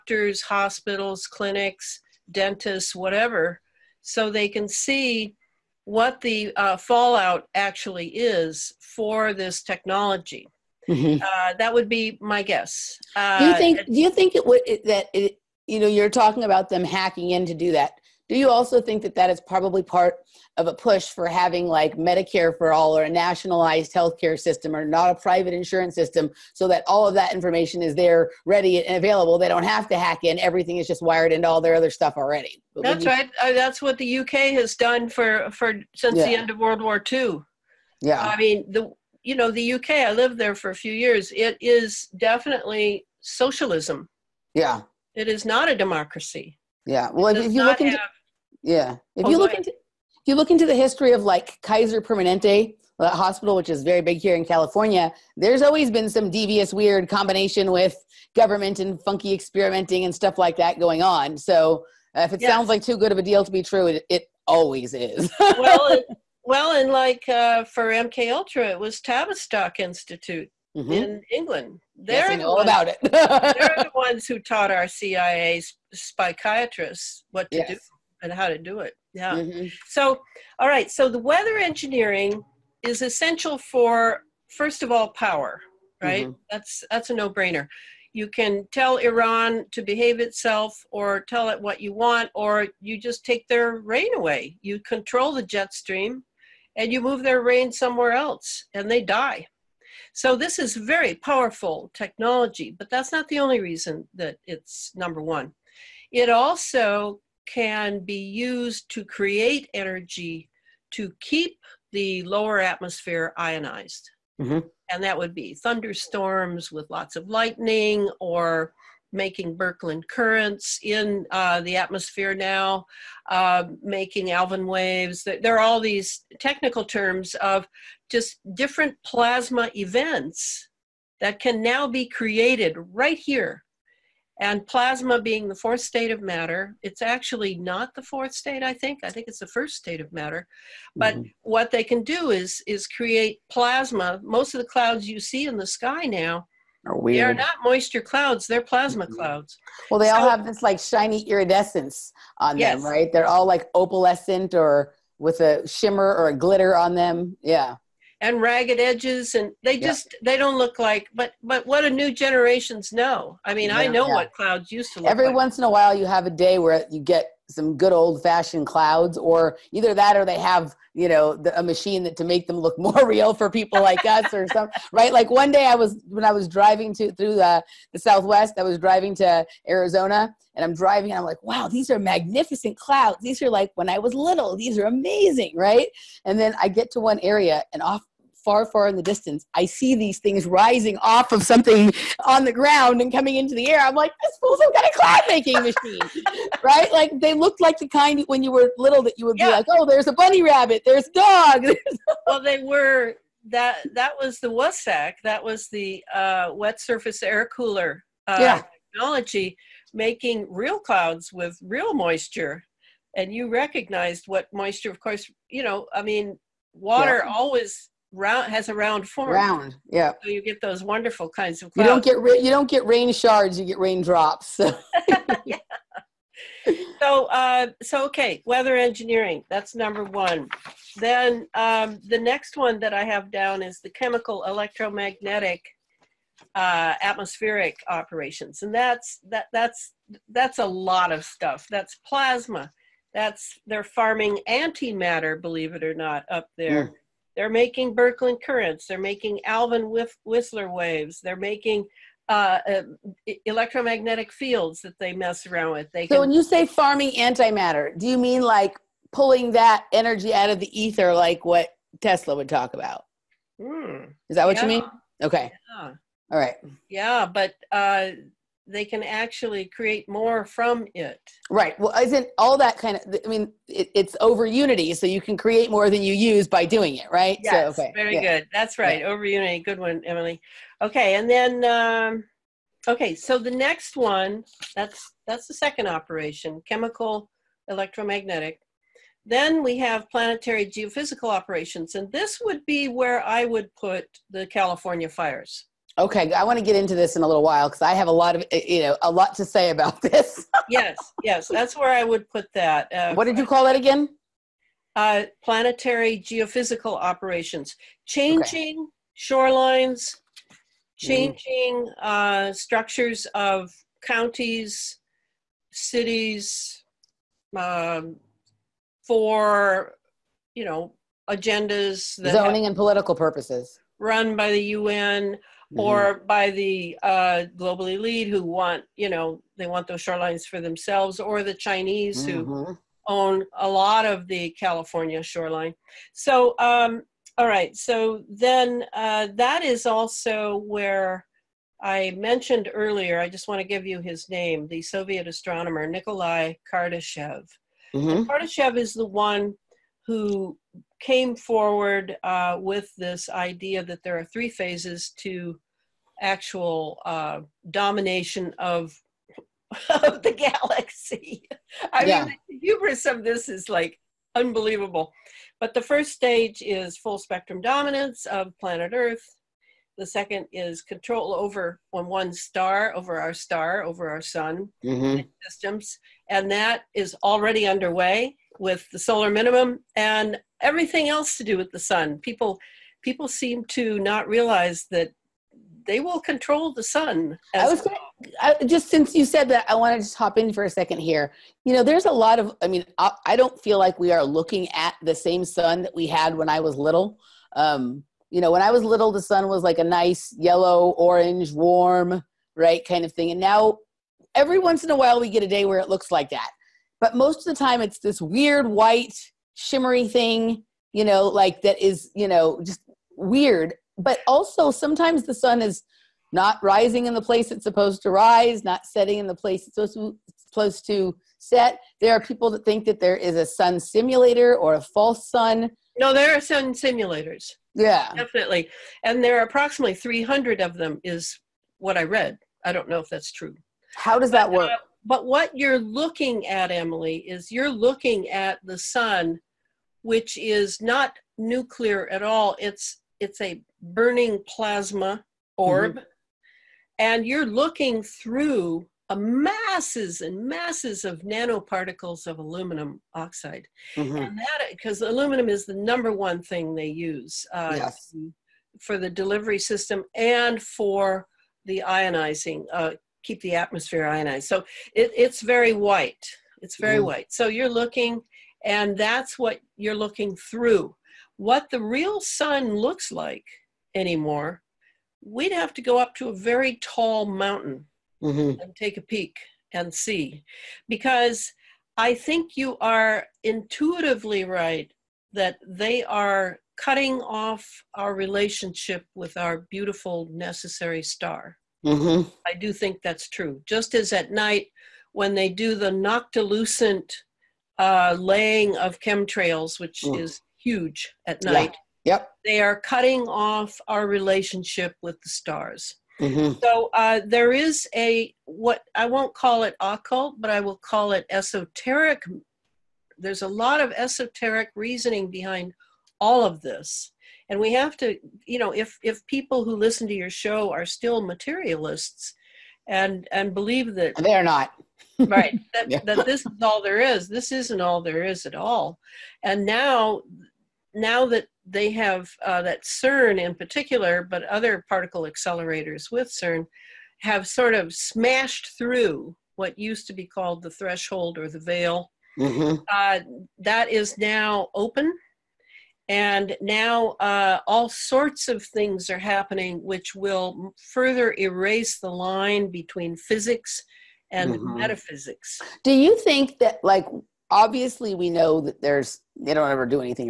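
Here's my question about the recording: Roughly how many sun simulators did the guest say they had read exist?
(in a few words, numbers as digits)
300.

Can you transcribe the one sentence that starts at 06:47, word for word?
But most of the time, it's this weird white, shimmery thing, you know, like that is, you know, just weird.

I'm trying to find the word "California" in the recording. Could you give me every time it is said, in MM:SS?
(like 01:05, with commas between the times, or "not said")
00:54, 04:54, 05:34.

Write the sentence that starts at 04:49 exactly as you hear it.
Then we have planetary geophysical operations.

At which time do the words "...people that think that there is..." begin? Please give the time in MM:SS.
07:02.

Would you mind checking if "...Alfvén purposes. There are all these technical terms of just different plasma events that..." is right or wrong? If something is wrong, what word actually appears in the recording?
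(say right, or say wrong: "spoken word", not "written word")
wrong: "waves", not "purposes".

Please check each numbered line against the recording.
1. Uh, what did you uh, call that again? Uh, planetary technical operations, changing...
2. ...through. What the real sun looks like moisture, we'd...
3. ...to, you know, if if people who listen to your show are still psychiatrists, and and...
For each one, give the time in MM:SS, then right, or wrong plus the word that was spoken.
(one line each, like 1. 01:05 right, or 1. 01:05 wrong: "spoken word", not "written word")
1. 05:02 wrong: "geophysical", not "technical"
2. 07:50 wrong: "anymore", not "moisture"
3. 08:37 wrong: "materialists", not "psychiatrists".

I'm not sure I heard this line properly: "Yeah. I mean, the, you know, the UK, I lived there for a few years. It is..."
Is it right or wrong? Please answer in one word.
right.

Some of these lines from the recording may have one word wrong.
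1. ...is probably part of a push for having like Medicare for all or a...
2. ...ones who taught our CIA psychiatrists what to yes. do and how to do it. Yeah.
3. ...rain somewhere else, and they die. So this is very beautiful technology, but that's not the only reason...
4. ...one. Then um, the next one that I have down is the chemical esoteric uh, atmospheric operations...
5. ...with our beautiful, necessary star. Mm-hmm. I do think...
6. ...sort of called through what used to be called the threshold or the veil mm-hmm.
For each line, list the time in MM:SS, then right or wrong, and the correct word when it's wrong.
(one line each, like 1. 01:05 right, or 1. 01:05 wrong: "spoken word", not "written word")
1. 00:19 right
2. 01:13 right
3. 01:37 wrong: "powerful", not "beautiful"
4. 03:50 wrong: "electromagnetic", not "esoteric"
5. 08:09 right
6. 08:57 wrong: "smashed", not "called".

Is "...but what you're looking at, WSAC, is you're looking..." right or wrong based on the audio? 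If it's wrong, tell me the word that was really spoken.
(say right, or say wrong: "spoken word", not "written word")
wrong: "Emily", not "WSAC".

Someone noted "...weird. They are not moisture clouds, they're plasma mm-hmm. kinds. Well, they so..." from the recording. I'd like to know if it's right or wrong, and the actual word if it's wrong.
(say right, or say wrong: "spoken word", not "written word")
wrong: "clouds", not "kinds".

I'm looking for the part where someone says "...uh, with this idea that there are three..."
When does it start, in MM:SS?
05:52.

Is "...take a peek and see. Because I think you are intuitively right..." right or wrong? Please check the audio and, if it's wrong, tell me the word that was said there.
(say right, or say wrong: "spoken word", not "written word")
right.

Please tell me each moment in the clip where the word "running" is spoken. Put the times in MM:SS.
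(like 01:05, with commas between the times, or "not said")
not said.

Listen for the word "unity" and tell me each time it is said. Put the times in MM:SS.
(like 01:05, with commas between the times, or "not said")
04:34, 04:39.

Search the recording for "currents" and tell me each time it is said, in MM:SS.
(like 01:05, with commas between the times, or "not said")
02:00, 04:08.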